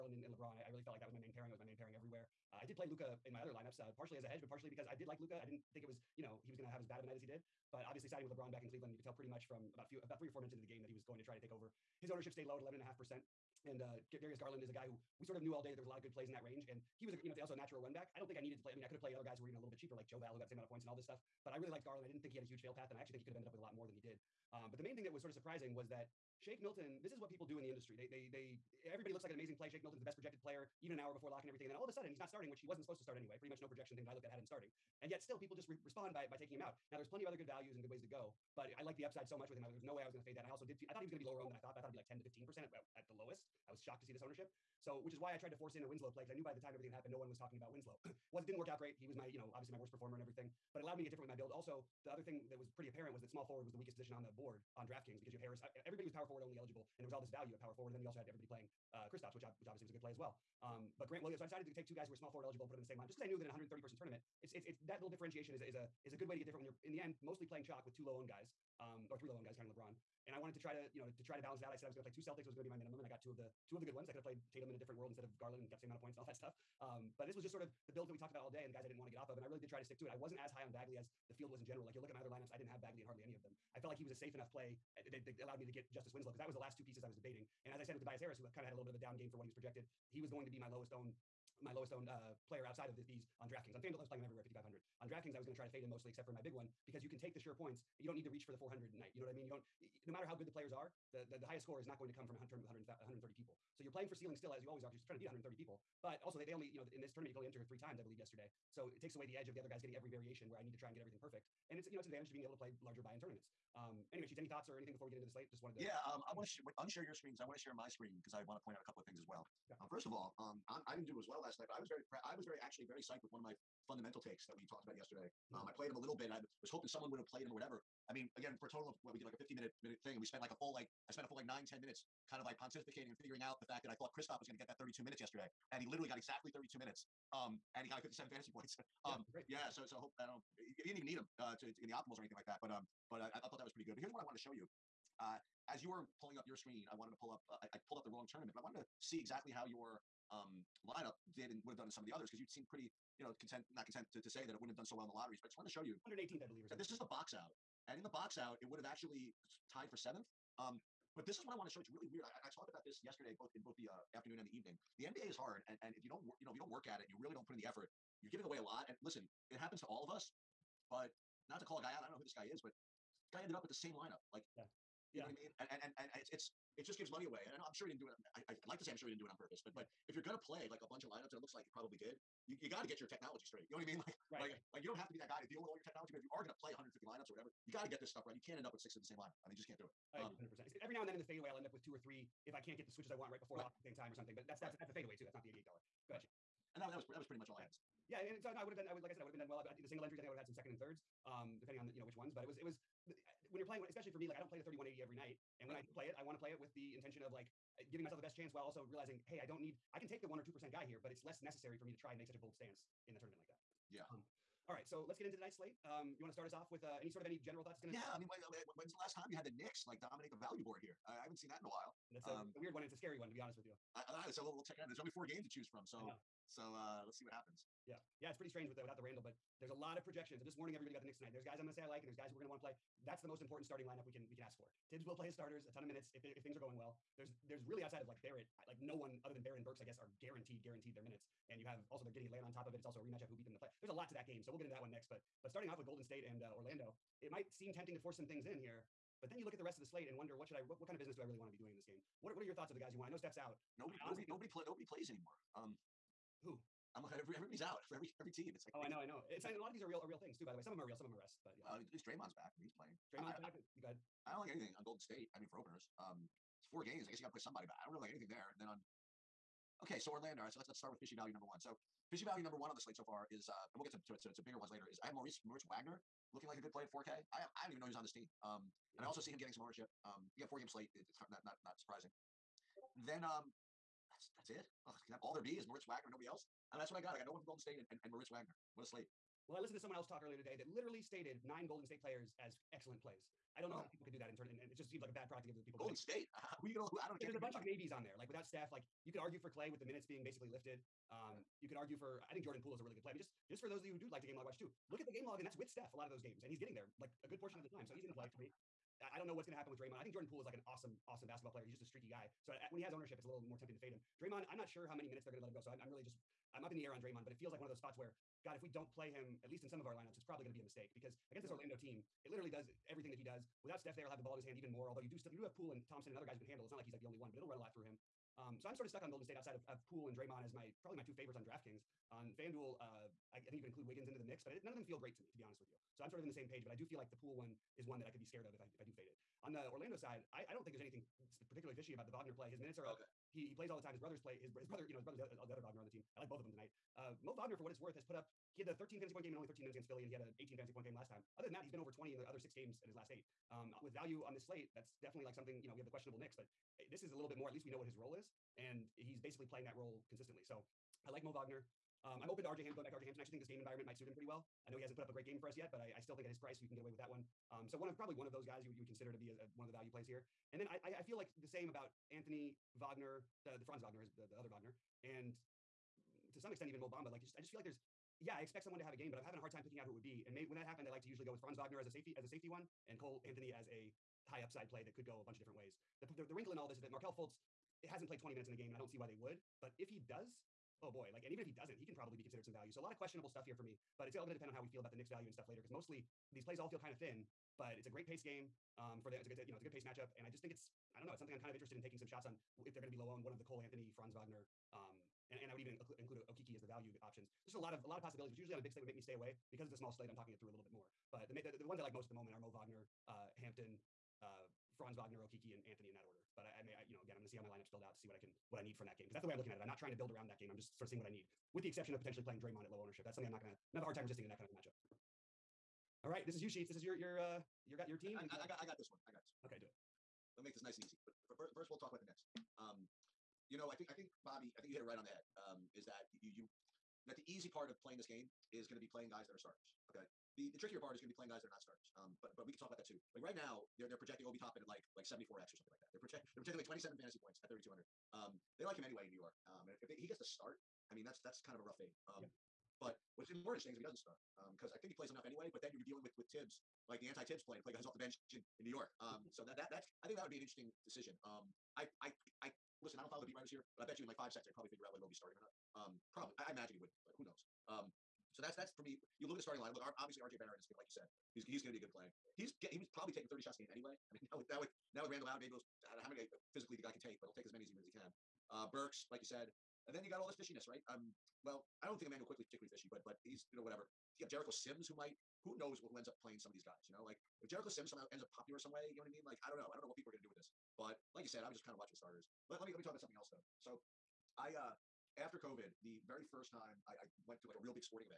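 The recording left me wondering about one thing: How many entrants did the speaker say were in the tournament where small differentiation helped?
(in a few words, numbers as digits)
130.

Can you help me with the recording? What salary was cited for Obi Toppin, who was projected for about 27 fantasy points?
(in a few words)
3200.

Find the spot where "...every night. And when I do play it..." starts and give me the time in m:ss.
3:25.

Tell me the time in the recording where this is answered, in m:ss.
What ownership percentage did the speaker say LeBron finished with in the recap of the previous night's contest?
0:12.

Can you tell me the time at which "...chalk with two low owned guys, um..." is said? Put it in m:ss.
1:07.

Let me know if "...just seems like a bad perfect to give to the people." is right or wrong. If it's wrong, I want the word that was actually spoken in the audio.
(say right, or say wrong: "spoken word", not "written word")
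wrong: "product", not "perfect".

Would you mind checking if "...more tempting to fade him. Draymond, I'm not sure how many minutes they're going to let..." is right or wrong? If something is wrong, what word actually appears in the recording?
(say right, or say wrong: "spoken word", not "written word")
right.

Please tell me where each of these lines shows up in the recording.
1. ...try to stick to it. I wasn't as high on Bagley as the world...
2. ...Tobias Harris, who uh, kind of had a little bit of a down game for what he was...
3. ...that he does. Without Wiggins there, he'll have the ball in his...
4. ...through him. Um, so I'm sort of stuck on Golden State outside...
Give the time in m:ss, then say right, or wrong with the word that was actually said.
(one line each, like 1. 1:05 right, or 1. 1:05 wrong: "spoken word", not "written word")
1. 1:19 wrong: "field", not "world"
2. 1:28 right
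3. 5:23 wrong: "Steph", not "Wiggins"
4. 5:27 right.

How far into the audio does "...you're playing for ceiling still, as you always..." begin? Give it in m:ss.
1:43.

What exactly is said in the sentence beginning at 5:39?
On the Orlando side, I, I don't think there's anything particularly fishy about the Wagner play.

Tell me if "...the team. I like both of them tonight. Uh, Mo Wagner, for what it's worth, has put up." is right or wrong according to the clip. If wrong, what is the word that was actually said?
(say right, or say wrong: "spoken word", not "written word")
right.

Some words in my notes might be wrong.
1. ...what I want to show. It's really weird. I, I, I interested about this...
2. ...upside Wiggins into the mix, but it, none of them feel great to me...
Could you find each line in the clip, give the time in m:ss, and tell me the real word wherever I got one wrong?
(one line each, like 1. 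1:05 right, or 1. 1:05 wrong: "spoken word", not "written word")
1. 2:41 wrong: "talked", not "interested"
2. 5:33 wrong: "include", not "upside".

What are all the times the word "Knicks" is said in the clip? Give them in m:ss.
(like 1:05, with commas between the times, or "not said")
3:39, 3:51, 5:56, 6:34.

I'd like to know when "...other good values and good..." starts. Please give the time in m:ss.
0:37.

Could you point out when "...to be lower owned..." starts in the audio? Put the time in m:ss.
0:41.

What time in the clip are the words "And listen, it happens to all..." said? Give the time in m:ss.
2:48.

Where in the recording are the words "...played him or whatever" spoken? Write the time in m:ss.
2:07.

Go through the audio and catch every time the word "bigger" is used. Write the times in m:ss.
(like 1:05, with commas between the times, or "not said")
4:34.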